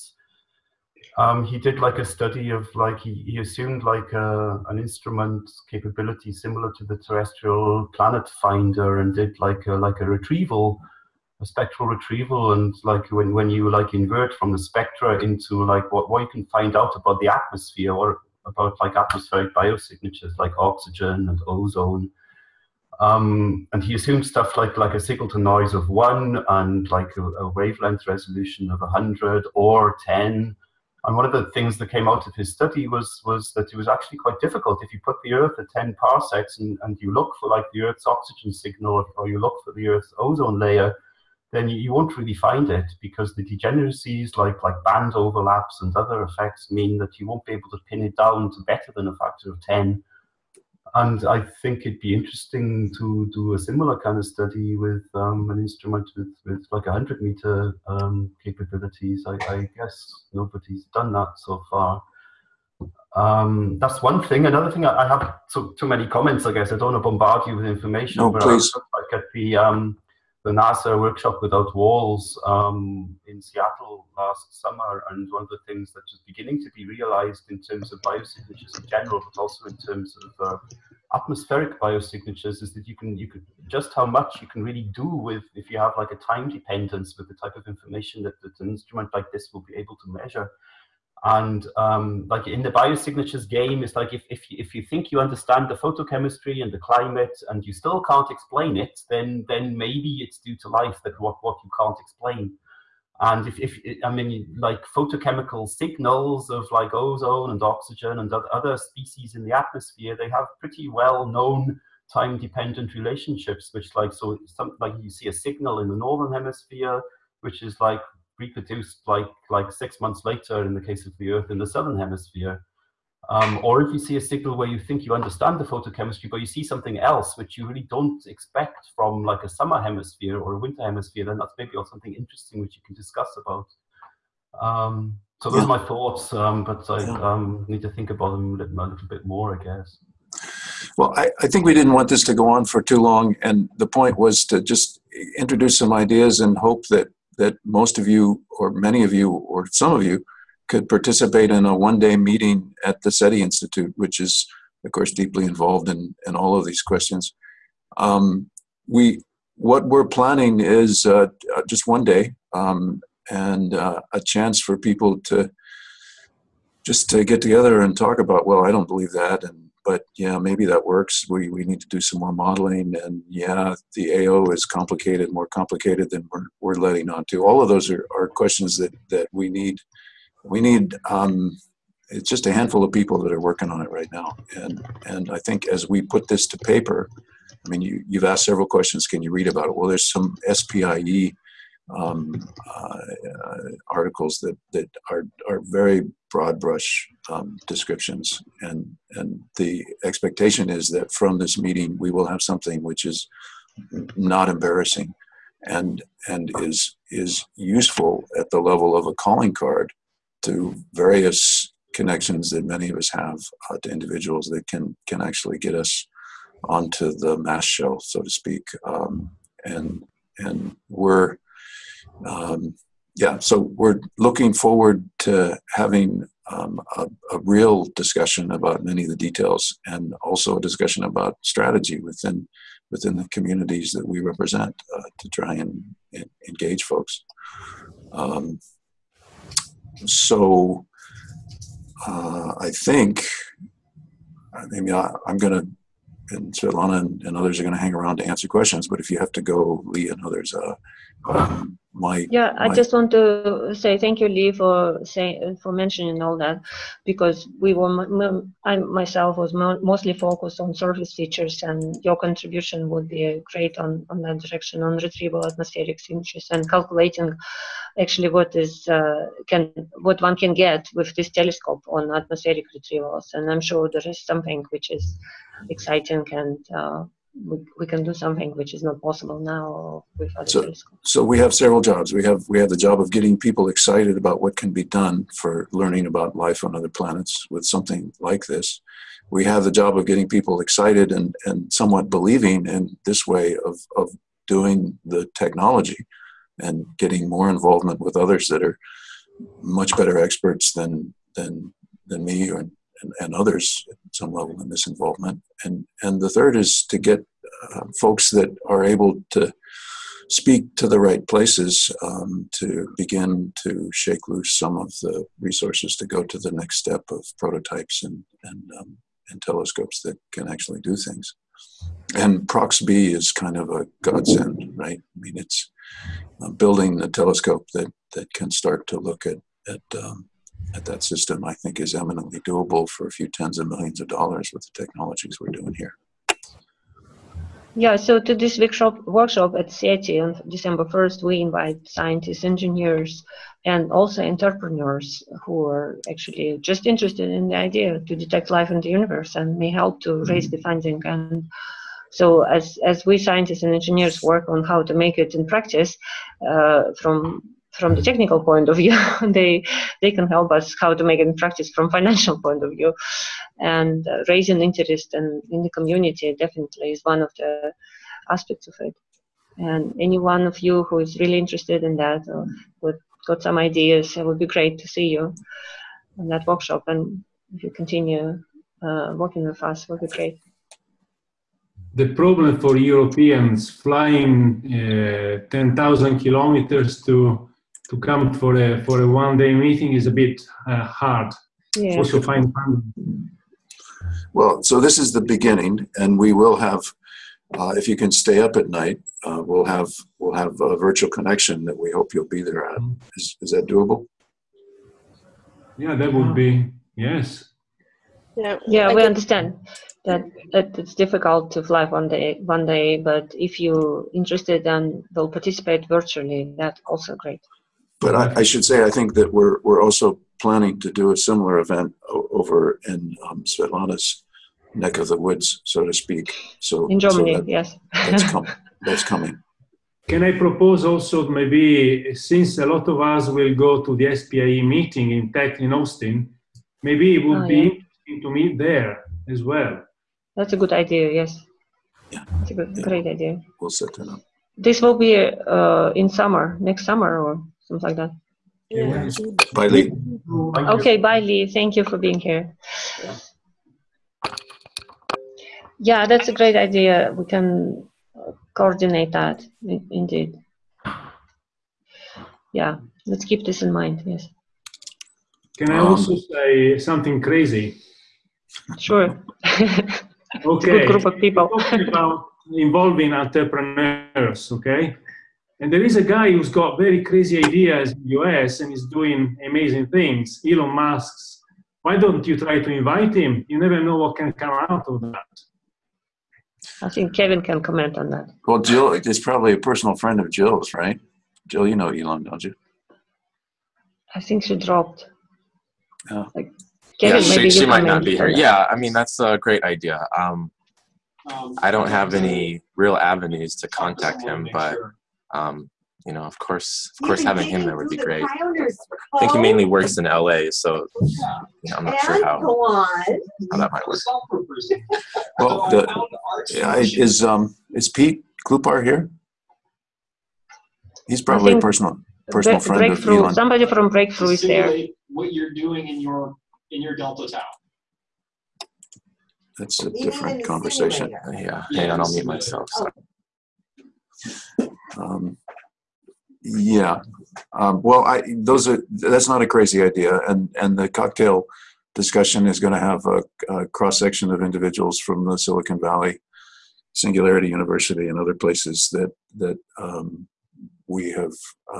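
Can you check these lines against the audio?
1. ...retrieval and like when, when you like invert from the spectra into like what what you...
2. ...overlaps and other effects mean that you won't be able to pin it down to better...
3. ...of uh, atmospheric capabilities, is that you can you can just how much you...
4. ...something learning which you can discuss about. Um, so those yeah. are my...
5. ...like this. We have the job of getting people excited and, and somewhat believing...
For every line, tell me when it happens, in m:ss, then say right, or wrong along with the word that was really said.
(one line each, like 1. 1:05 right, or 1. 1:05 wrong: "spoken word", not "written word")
1. 0:11 right
2. 0:45 right
3. 1:20 wrong: "biosignatures", not "capabilities"
4. 2:11 wrong: "interesting", not "learning"
5. 4:48 right.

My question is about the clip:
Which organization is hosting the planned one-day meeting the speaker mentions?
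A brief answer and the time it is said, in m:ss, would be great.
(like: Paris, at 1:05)
SETI Institute, at 2:33.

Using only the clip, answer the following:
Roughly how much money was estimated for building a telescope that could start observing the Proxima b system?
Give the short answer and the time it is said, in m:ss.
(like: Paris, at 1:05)
a few tens of millions of dollars, at 5:33.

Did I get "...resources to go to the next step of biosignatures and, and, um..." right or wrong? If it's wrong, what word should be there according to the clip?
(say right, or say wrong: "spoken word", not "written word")
wrong: "prototypes", not "biosignatures".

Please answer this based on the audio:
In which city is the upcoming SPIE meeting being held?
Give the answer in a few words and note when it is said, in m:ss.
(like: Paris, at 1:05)
Austin, at 7:15.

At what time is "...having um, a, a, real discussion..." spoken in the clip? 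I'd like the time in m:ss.
3:45.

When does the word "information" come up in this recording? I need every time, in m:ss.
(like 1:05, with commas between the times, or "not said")
1:07, 1:27.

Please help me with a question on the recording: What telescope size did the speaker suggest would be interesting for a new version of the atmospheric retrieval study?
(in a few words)
100 meter.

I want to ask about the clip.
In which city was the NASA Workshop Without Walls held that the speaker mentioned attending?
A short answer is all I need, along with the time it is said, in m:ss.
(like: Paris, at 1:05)
Seattle, at 1:13.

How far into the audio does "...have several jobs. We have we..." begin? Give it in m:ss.
4:41.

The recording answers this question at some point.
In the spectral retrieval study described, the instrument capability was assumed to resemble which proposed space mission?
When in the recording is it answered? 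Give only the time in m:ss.
0:06.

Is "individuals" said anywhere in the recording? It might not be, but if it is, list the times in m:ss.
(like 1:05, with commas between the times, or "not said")
3:33, 9:04.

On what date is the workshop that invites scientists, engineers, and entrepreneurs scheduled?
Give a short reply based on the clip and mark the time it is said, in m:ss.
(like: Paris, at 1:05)
December 1st, at 5:40.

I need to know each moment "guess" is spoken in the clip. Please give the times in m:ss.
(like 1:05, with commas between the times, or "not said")
0:59, 1:06, 2:19.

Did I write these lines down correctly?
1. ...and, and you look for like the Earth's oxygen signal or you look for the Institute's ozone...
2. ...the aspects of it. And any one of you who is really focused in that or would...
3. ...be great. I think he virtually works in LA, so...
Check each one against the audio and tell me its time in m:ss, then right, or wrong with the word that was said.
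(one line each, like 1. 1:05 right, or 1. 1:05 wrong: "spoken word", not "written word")
1. 0:36 wrong: "Earth", not "Institute"
2. 6:07 wrong: "interested", not "focused"
3. 8:27 wrong: "mainly", not "virtually".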